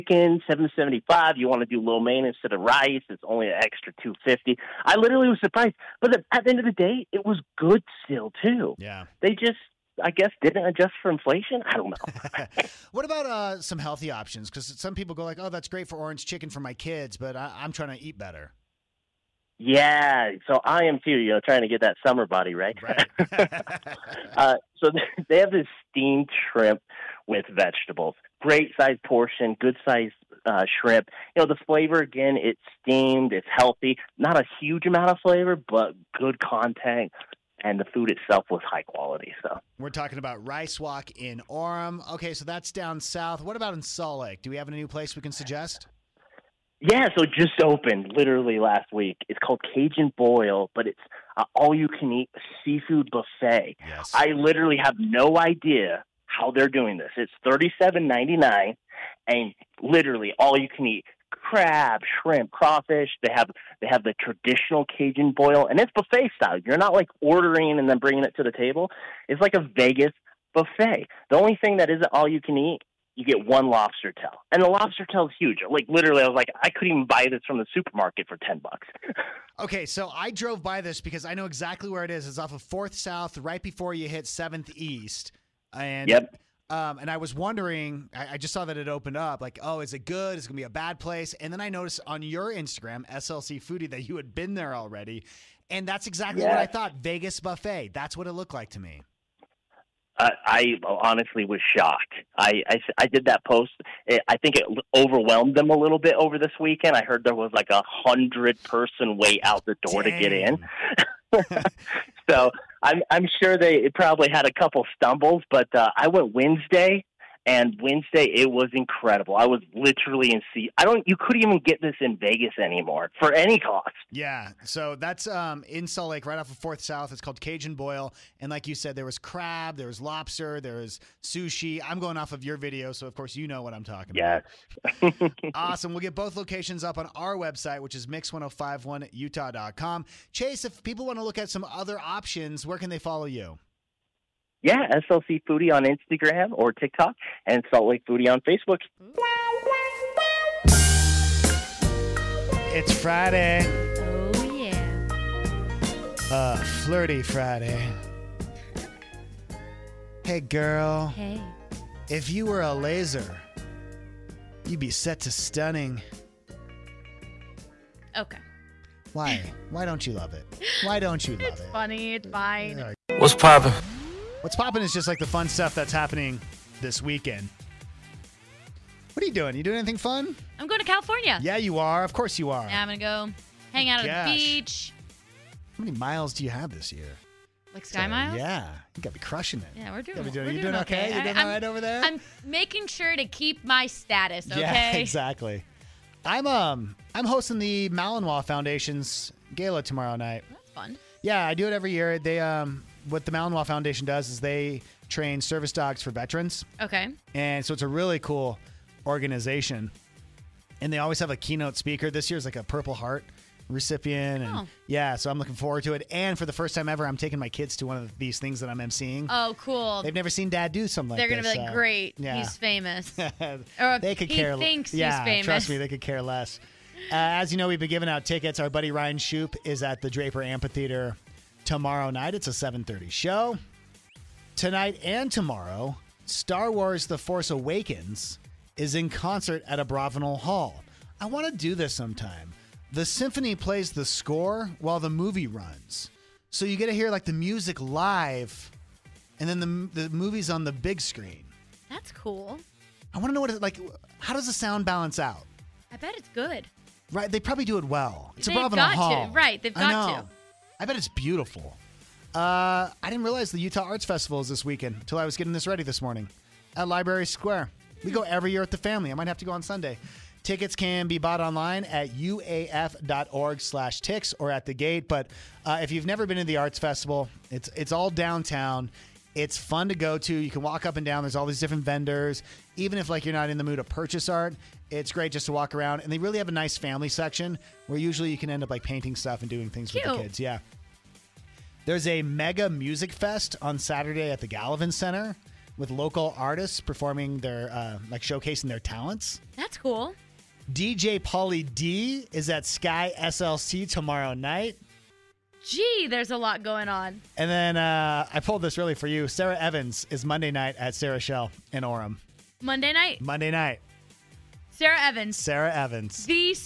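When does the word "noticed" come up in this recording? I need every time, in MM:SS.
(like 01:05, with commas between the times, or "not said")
01:31.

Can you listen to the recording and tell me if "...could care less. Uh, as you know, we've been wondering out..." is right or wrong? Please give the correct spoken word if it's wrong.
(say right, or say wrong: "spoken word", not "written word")
wrong: "giving", not "wondering".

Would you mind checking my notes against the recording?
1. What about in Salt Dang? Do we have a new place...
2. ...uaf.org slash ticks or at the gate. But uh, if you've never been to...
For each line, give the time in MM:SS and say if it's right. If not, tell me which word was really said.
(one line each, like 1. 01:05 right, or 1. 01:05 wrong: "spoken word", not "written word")
1. 00:43 wrong: "Lake", not "Dang"
2. 04:32 right.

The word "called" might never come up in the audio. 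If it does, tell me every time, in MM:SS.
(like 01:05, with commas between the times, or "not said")
00:49, 02:07.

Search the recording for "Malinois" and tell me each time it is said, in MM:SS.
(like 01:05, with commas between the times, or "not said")
03:17, 03:23.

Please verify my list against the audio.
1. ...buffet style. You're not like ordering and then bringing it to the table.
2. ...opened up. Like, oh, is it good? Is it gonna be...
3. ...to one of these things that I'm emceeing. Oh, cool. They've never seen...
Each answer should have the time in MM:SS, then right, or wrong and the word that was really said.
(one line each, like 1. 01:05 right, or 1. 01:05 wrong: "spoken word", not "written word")
1. 01:05 right
2. 01:28 right
3. 03:37 right.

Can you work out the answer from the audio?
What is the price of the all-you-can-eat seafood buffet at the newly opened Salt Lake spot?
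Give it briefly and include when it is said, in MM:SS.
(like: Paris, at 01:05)
$37.99, at 00:57.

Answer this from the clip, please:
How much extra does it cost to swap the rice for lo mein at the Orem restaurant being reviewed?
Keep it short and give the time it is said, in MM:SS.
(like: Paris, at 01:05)
$2.50, at 00:04.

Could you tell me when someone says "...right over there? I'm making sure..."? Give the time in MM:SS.
03:11.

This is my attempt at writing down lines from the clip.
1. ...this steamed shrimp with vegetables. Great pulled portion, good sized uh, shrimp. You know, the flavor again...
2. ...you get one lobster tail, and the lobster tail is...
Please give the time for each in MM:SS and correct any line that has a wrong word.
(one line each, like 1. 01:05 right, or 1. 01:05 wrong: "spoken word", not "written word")
1. 00:25 wrong: "sized", not "pulled"
2. 01:13 right.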